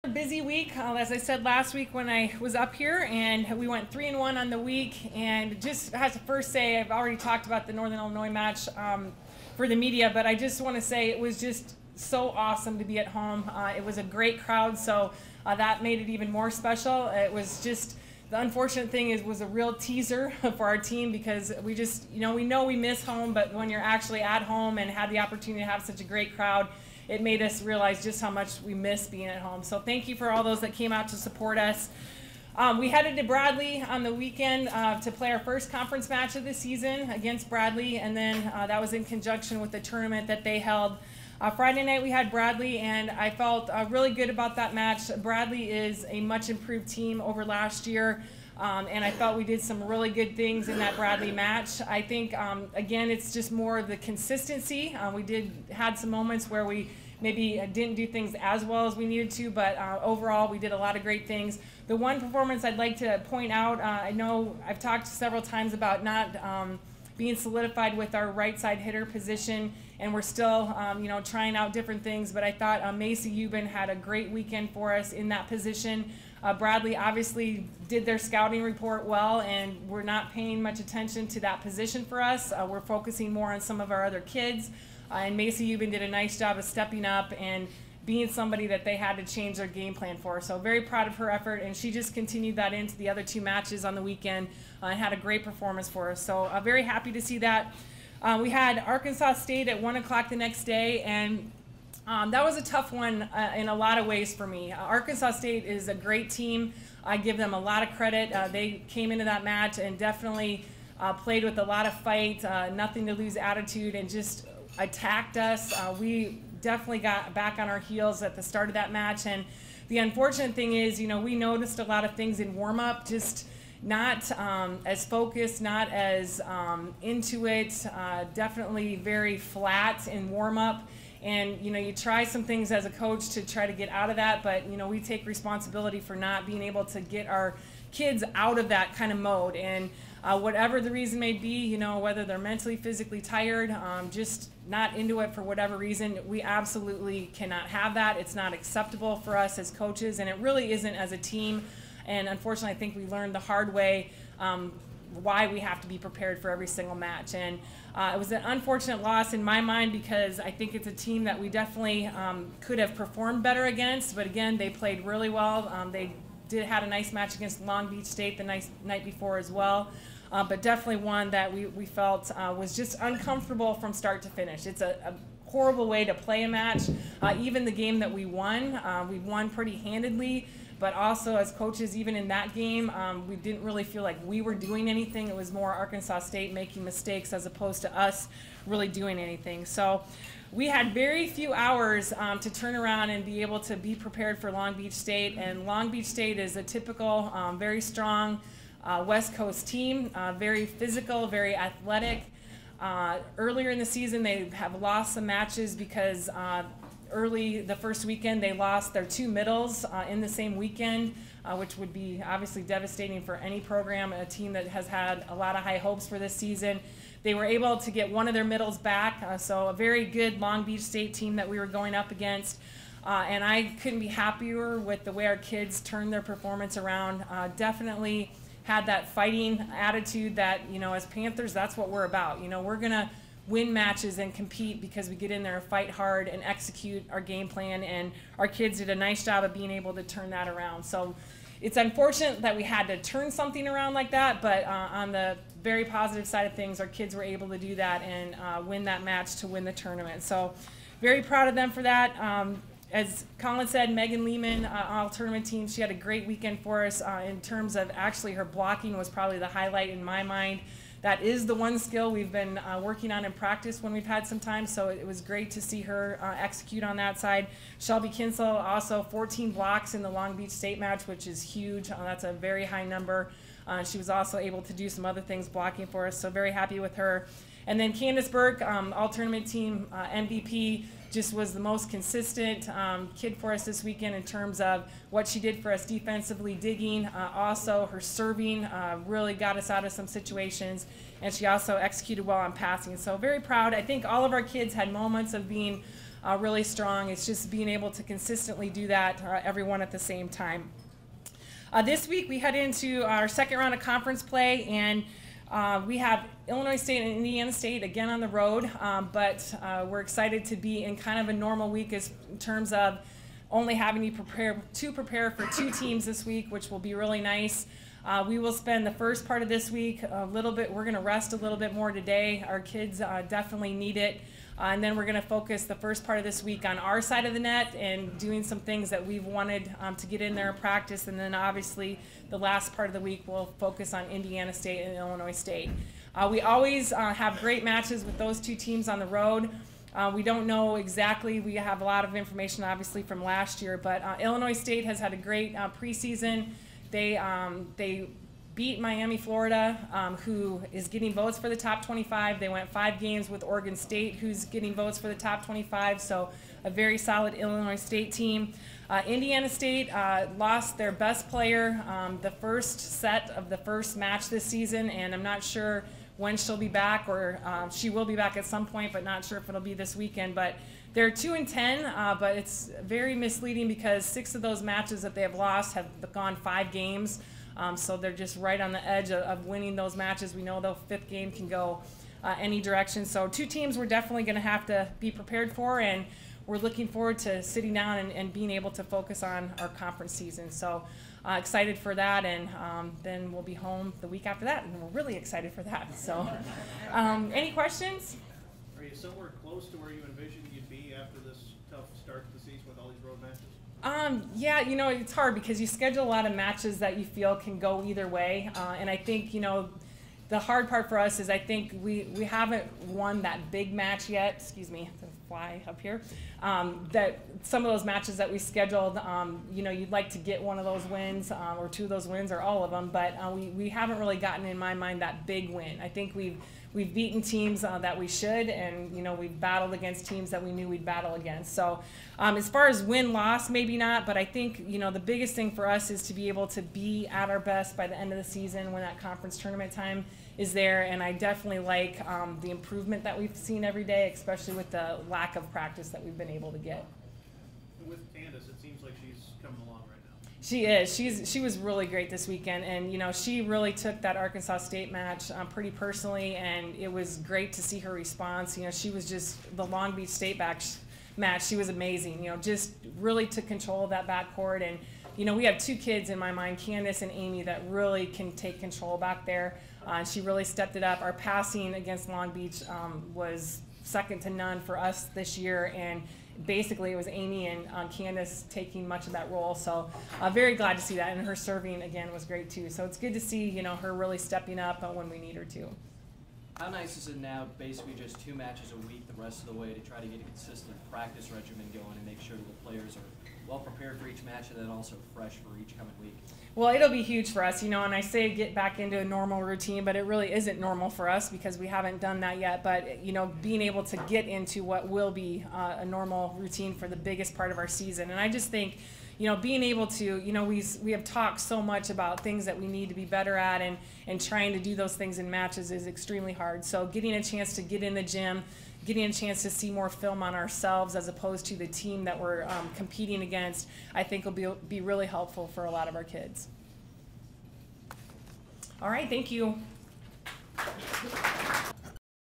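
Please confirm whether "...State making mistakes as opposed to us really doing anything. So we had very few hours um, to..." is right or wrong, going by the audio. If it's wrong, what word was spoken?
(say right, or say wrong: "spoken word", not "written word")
right.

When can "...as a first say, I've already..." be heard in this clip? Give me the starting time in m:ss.
0:05.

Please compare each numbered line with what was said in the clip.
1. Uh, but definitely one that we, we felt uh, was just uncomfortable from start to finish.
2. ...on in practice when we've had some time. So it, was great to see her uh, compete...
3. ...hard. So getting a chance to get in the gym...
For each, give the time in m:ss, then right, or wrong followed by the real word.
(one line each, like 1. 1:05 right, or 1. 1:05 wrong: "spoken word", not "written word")
1. 2:50 right
2. 4:23 wrong: "execute", not "compete"
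3. 8:36 right.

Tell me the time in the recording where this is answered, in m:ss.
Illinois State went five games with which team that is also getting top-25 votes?
5:53.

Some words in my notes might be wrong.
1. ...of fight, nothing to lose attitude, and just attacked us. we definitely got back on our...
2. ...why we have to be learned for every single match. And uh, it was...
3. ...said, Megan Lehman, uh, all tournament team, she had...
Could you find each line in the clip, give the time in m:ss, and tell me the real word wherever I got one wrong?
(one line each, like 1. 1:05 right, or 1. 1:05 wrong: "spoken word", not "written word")
1. 1:51 right
2. 2:35 wrong: "prepared", not "learned"
3. 4:13 right.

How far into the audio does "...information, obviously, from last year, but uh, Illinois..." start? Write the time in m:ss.
5:42.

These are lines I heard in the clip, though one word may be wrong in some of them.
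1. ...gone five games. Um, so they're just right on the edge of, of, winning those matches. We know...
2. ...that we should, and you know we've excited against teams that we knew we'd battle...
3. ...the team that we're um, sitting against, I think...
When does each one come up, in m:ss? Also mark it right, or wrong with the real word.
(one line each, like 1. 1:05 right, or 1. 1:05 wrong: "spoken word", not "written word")
1. 6:16 right
2. 7:07 wrong: "battled", not "excited"
3. 8:41 wrong: "competing", not "sitting".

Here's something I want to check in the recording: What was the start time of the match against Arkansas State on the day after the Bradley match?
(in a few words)
1 o'clock.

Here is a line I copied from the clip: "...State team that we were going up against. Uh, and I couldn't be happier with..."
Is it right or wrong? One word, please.
right.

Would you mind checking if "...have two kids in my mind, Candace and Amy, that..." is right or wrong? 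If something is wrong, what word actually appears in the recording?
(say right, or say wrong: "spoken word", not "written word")
right.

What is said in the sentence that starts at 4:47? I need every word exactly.
Uh, also, her serving uh, really got us out of some situations, and she also executed well on passing.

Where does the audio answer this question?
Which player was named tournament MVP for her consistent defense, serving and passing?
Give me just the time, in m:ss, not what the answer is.
4:37.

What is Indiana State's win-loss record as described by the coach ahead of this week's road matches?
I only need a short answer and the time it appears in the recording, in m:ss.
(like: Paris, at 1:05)
2-10, at 6:11.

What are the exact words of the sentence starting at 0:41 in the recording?
Uh, Friday night we had Bradley, and I felt uh, really good about that match.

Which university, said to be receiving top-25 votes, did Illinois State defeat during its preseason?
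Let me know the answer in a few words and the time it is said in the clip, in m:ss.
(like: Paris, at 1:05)
Miami, Florida, at 5:48.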